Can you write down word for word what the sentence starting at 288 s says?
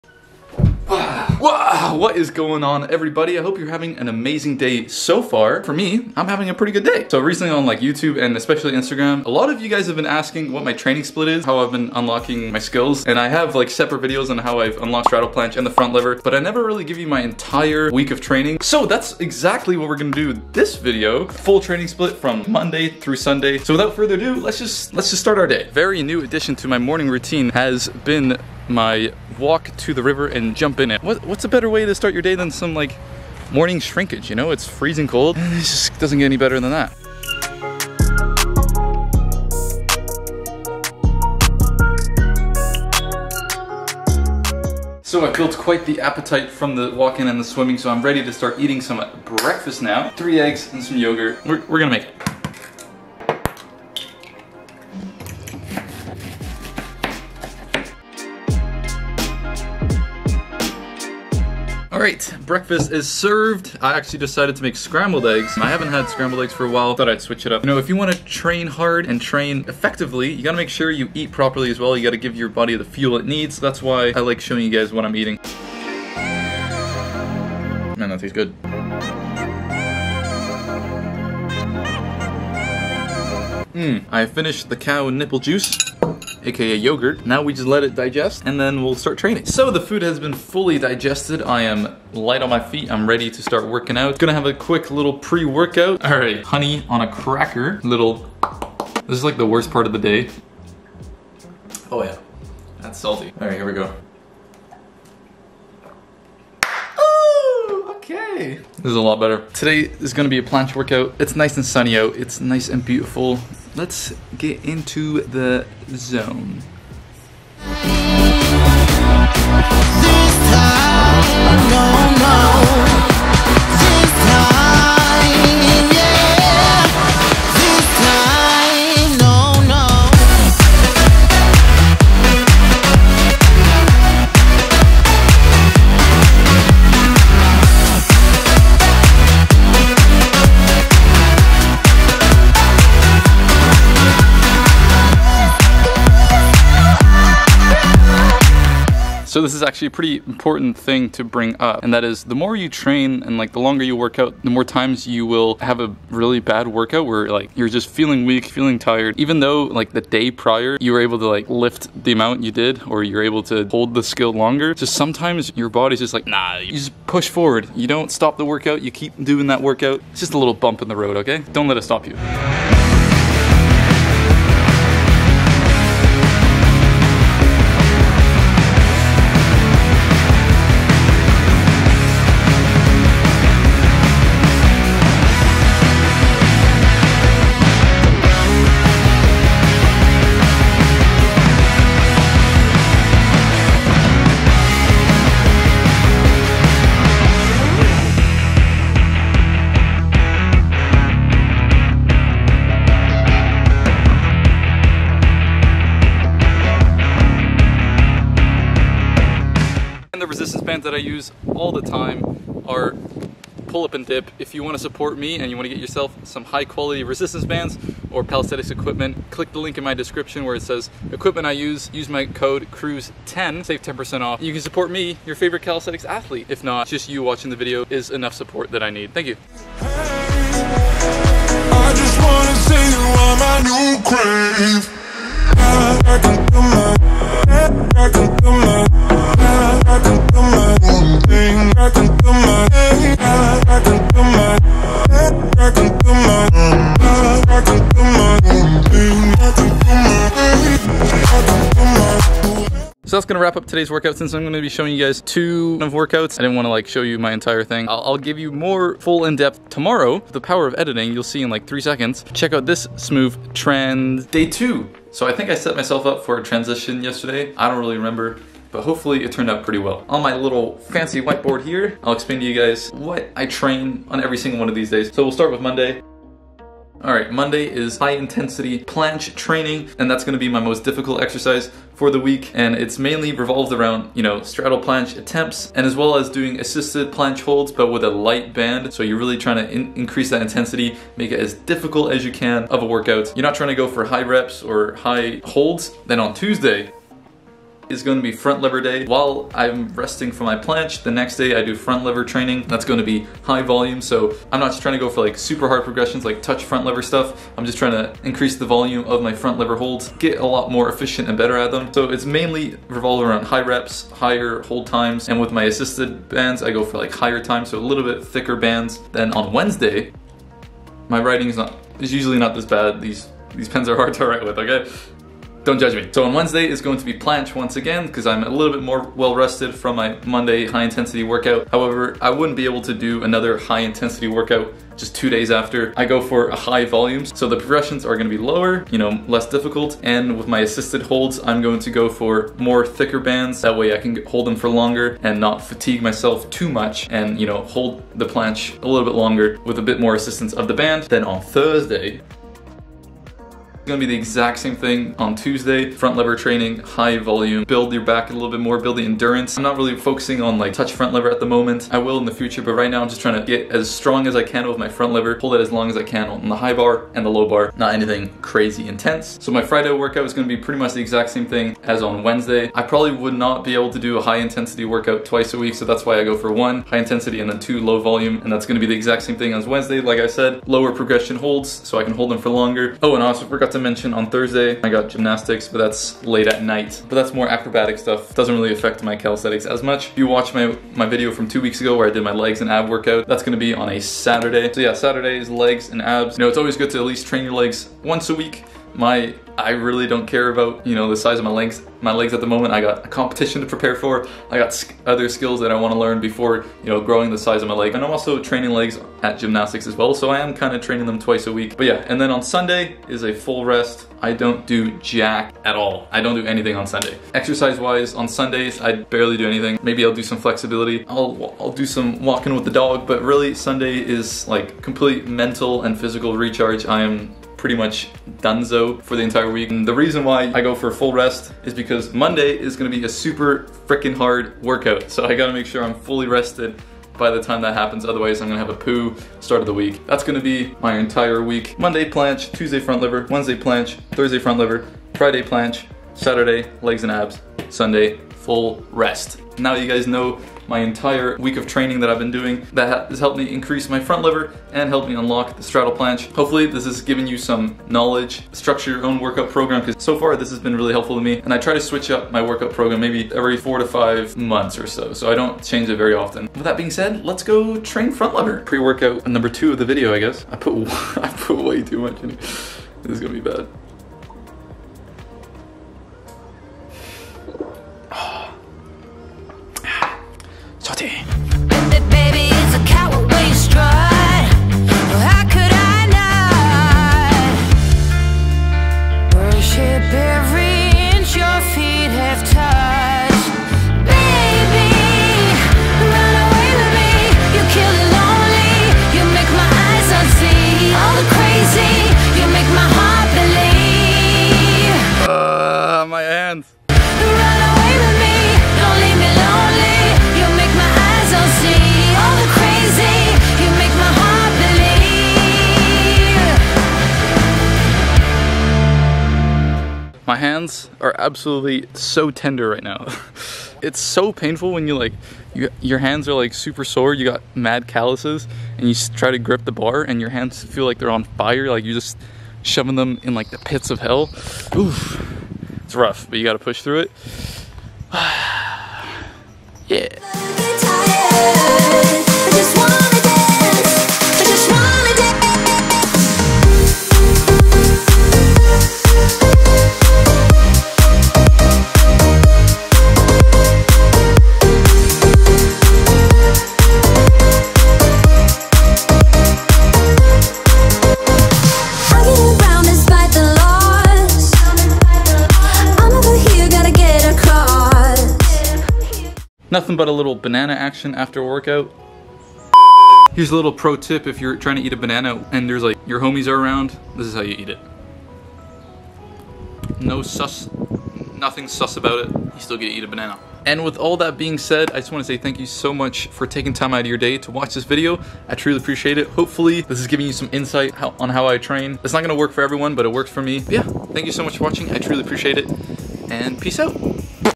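So you're really trying to in increase that intensity, make it as difficult as you can of a workout.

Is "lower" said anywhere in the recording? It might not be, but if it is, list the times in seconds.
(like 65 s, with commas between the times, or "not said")
338 s, 380 s.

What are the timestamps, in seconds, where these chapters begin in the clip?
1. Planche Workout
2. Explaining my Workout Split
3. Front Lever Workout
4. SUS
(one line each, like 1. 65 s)
1. 109 s
2. 264 s
3. 468 s
4. 570 s.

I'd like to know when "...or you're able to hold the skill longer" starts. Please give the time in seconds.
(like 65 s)
162 s.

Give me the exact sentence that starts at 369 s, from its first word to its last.
So my Friday workout is gonna be pretty much the exact same thing as on Wednesday.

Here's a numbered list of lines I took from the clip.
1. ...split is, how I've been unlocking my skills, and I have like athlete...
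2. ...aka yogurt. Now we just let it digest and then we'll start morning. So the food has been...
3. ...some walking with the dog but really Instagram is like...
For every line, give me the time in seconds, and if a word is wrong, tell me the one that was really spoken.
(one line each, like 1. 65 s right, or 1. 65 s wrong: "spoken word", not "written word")
1. 11 s wrong: "separate", not "athlete"
2. 86 s wrong: "training", not "morning"
3. 421 s wrong: "Sunday", not "Instagram".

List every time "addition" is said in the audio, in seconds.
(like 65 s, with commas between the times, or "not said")
26 s.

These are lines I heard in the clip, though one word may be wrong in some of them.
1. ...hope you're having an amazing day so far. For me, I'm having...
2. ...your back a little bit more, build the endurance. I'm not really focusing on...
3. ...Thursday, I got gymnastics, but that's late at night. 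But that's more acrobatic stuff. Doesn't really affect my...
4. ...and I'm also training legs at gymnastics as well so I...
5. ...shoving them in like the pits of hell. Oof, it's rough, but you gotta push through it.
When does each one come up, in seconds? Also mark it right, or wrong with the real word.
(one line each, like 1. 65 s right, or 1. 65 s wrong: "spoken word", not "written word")
1. 3 s right
2. 357 s right
3. 384 s right
4. 407 s right
5. 532 s right.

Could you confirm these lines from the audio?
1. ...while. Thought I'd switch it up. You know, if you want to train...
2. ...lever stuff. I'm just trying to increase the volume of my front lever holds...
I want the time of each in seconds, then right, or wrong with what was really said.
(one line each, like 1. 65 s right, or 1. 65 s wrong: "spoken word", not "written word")
1. 66 s right
2. 306 s right.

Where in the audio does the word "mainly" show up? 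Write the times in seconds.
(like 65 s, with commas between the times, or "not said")
282 s, 312 s.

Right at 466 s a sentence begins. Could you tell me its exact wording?
With that being said, let's go train front lever.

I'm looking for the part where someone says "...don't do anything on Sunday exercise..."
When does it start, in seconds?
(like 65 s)
416 s.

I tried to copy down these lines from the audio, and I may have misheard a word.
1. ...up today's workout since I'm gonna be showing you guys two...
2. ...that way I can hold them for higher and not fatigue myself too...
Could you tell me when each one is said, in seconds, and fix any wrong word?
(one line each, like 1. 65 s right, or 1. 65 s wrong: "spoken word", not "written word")
1. 253 s right
2. 343 s wrong: "longer", not "higher".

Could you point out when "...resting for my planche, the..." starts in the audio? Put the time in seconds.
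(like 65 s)
299 s.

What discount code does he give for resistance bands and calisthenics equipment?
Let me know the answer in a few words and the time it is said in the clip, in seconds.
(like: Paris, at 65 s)
CRUZ10, at 222 s.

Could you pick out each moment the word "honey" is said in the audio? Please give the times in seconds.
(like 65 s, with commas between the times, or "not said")
96 s.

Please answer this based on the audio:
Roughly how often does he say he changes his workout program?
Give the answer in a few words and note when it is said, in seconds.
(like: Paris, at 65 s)
Every 4 to 5 months, at 463 s.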